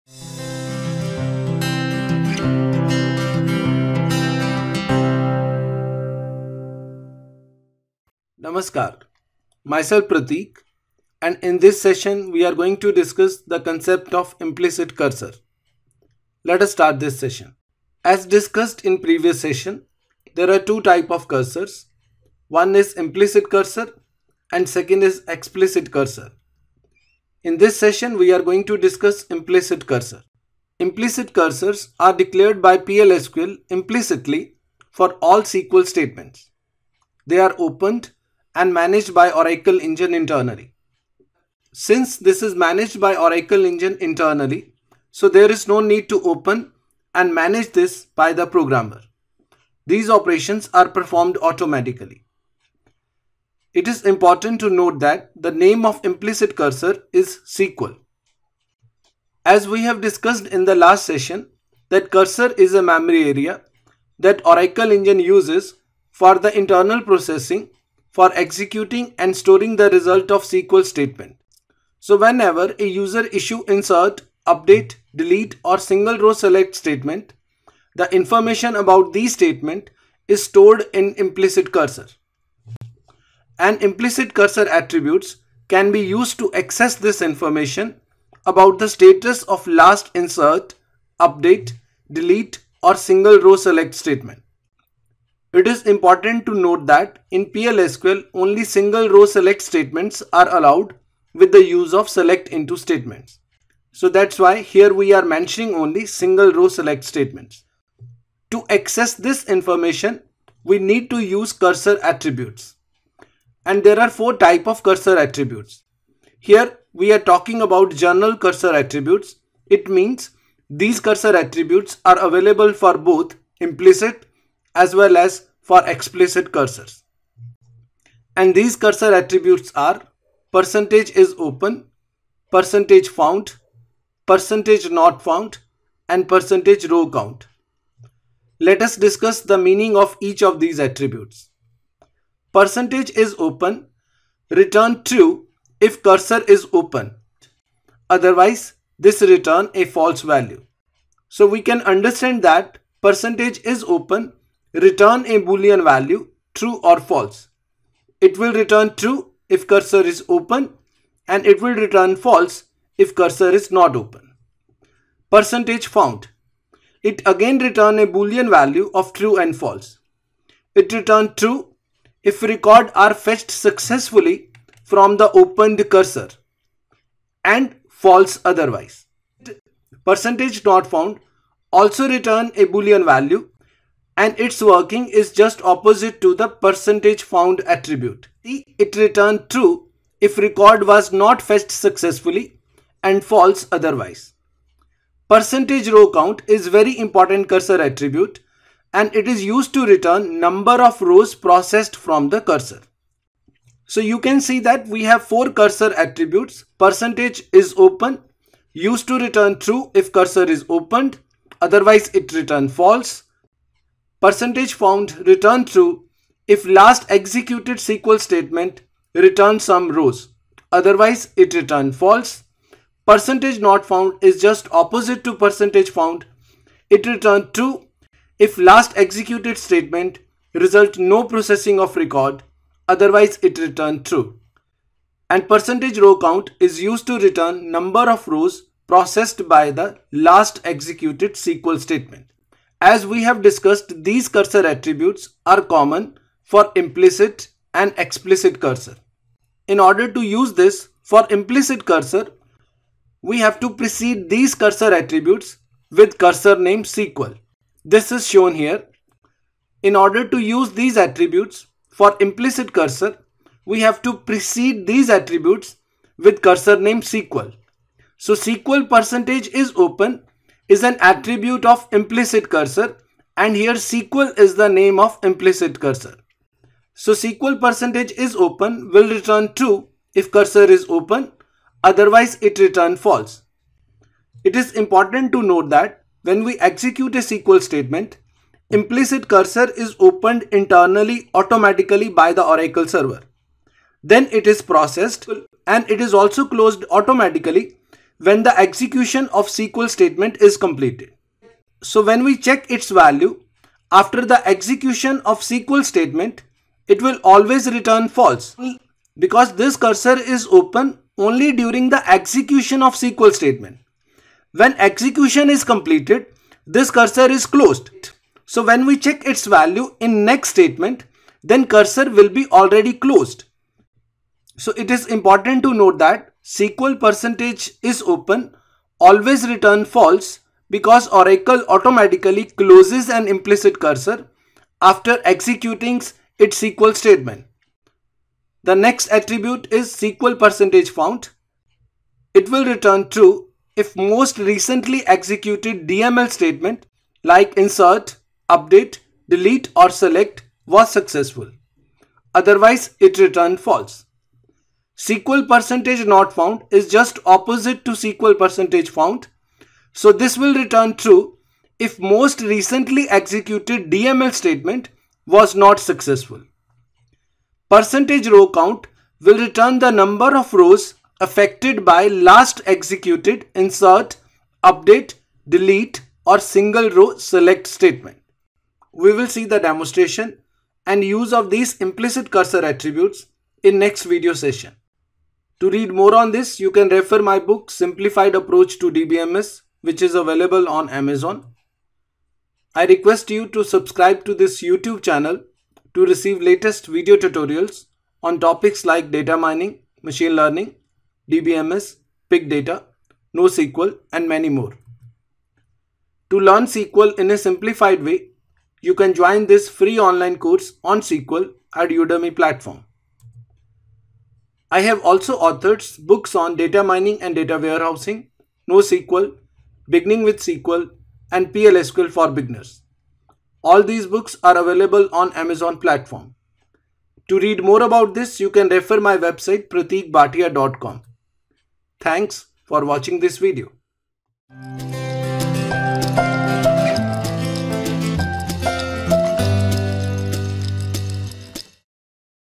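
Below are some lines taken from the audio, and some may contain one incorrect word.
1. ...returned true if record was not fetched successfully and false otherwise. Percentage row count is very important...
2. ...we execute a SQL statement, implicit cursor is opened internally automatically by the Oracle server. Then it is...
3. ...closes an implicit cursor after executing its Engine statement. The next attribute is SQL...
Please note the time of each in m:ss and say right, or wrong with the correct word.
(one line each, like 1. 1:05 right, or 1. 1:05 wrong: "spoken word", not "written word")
1. 3:08 right
2. 4:46 right
3. 5:32 wrong: "SQL", not "Engine".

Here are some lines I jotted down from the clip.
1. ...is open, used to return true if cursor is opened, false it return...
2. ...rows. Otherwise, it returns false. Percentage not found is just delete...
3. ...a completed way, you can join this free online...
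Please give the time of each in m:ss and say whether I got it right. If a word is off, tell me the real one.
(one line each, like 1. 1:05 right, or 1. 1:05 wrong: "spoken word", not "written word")
1. 3:27 wrong: "otherwise", not "false"
2. 3:39 wrong: "opposite", not "delete"
3. 6:47 wrong: "simplified", not "completed".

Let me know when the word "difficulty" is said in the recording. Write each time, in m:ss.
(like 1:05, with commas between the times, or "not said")
not said.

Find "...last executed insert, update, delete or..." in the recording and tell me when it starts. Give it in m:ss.
6:12.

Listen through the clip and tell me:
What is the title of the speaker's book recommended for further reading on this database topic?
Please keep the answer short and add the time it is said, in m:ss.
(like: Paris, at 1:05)
Simplified Approach to DBMS, at 6:27.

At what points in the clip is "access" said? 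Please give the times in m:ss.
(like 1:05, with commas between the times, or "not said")
1:26, 1:48.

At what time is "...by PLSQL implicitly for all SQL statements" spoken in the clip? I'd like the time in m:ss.
0:32.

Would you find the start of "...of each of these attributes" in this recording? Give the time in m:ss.
2:19.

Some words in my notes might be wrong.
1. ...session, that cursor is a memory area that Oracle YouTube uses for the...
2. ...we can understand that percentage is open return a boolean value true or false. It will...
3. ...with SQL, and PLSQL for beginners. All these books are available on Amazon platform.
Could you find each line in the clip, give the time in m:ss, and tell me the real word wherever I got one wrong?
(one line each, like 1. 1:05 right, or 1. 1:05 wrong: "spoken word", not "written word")
1. 1:01 wrong: "Engine", not "YouTube"
2. 2:31 right
3. 7:00 right.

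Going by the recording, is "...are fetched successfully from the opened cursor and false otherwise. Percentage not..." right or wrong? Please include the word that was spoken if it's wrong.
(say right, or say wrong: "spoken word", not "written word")
right.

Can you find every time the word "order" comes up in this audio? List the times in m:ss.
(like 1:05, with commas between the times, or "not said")
4:09, 4:19.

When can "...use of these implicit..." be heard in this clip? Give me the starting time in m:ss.
6:21.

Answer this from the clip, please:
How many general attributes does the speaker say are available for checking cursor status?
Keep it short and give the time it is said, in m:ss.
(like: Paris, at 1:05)
4, at 1:54.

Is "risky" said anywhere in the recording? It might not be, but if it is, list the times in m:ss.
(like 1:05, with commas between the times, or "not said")
not said.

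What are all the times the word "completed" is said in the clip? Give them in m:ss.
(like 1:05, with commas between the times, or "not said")
5:00, 5:15.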